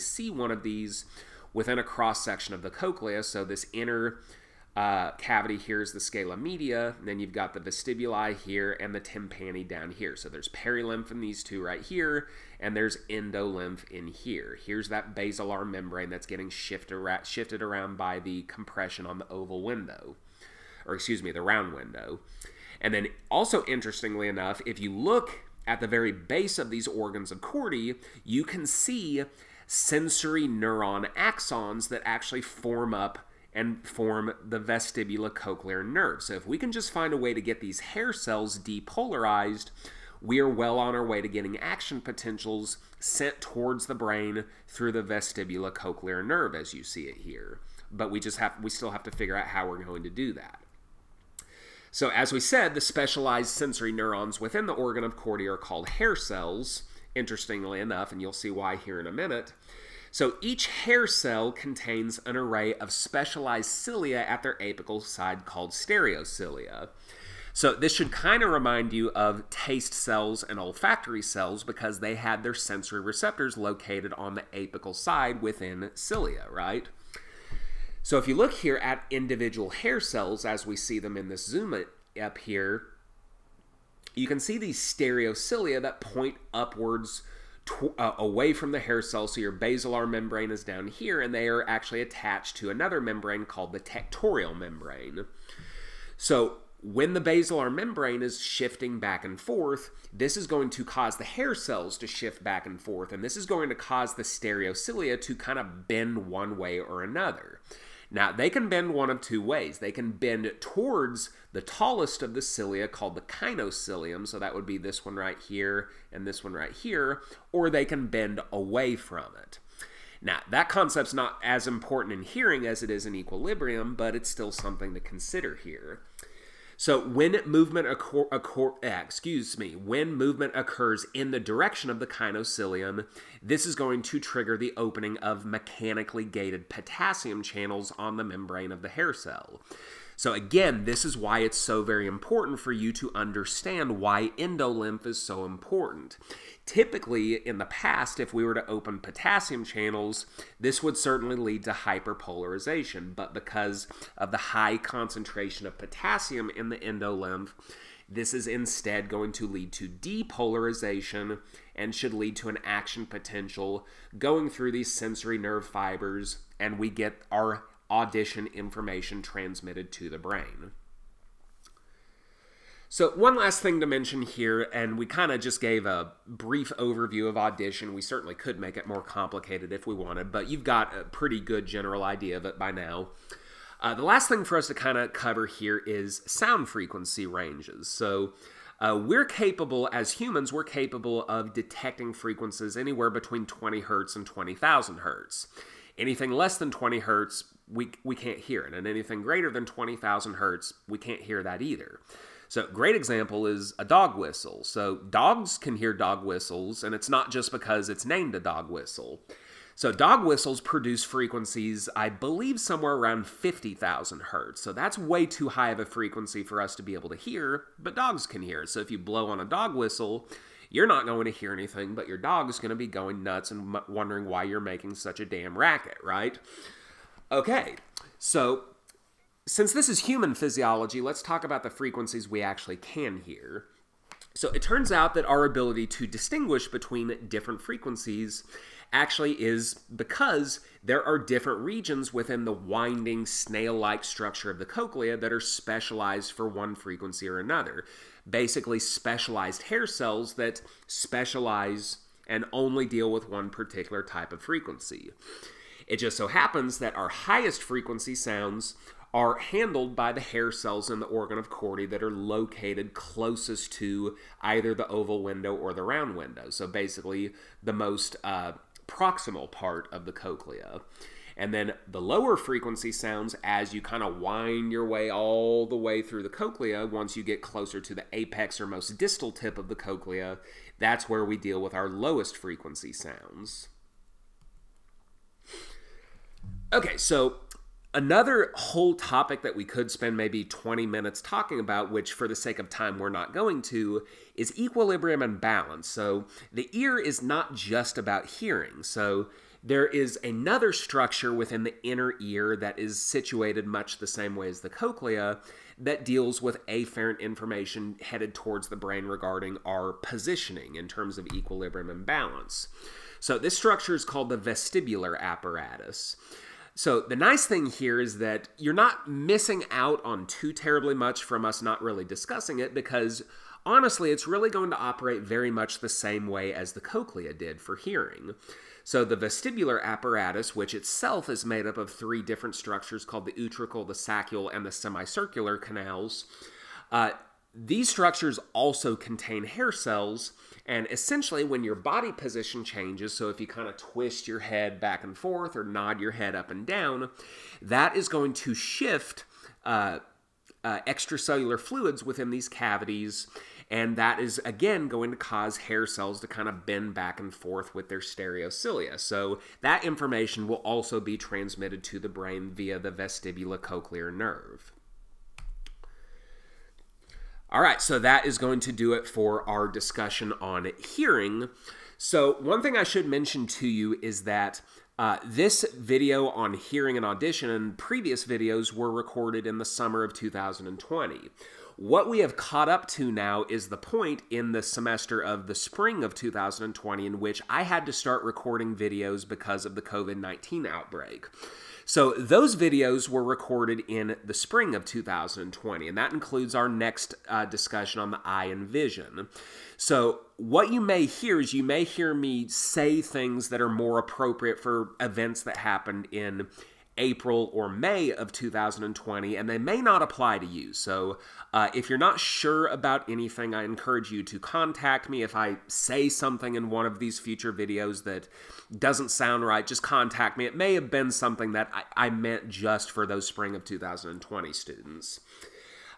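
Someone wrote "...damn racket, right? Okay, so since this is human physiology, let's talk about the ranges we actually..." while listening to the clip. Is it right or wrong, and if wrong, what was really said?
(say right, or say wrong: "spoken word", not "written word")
wrong: "frequencies", not "ranges".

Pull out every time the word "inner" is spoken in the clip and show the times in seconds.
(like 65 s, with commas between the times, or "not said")
3 s, 301 s.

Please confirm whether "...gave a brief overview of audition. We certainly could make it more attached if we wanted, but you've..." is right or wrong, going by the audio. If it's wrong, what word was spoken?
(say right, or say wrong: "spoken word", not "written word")
wrong: "complicated", not "attached".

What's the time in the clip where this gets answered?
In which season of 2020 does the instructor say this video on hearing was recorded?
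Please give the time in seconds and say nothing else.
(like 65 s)
379 s.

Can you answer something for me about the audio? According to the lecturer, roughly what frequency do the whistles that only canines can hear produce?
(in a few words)
50,000 hertz.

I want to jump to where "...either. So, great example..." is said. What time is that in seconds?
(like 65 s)
201 s.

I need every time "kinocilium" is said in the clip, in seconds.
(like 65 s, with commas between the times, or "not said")
113 s, 132 s.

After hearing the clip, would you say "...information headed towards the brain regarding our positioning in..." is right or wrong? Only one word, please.
right.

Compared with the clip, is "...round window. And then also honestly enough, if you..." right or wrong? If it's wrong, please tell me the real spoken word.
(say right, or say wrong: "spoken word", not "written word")
wrong: "interestingly", not "honestly".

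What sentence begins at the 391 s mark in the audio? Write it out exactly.
So those videos were recorded in the spring of 2020, and that includes our next uh, discussion on the eye and vision.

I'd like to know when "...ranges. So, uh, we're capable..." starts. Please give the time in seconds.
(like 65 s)
187 s.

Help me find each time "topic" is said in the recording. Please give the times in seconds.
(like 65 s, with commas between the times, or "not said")
288 s.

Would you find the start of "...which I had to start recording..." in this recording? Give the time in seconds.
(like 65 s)
387 s.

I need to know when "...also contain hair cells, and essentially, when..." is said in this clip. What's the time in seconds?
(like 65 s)
338 s.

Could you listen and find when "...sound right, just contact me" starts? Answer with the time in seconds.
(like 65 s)
419 s.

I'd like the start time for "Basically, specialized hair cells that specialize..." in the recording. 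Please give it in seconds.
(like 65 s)
248 s.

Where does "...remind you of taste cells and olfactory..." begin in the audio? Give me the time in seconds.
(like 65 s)
68 s.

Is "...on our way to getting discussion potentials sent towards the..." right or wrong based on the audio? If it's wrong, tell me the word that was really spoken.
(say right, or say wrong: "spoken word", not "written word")
wrong: "action", not "discussion".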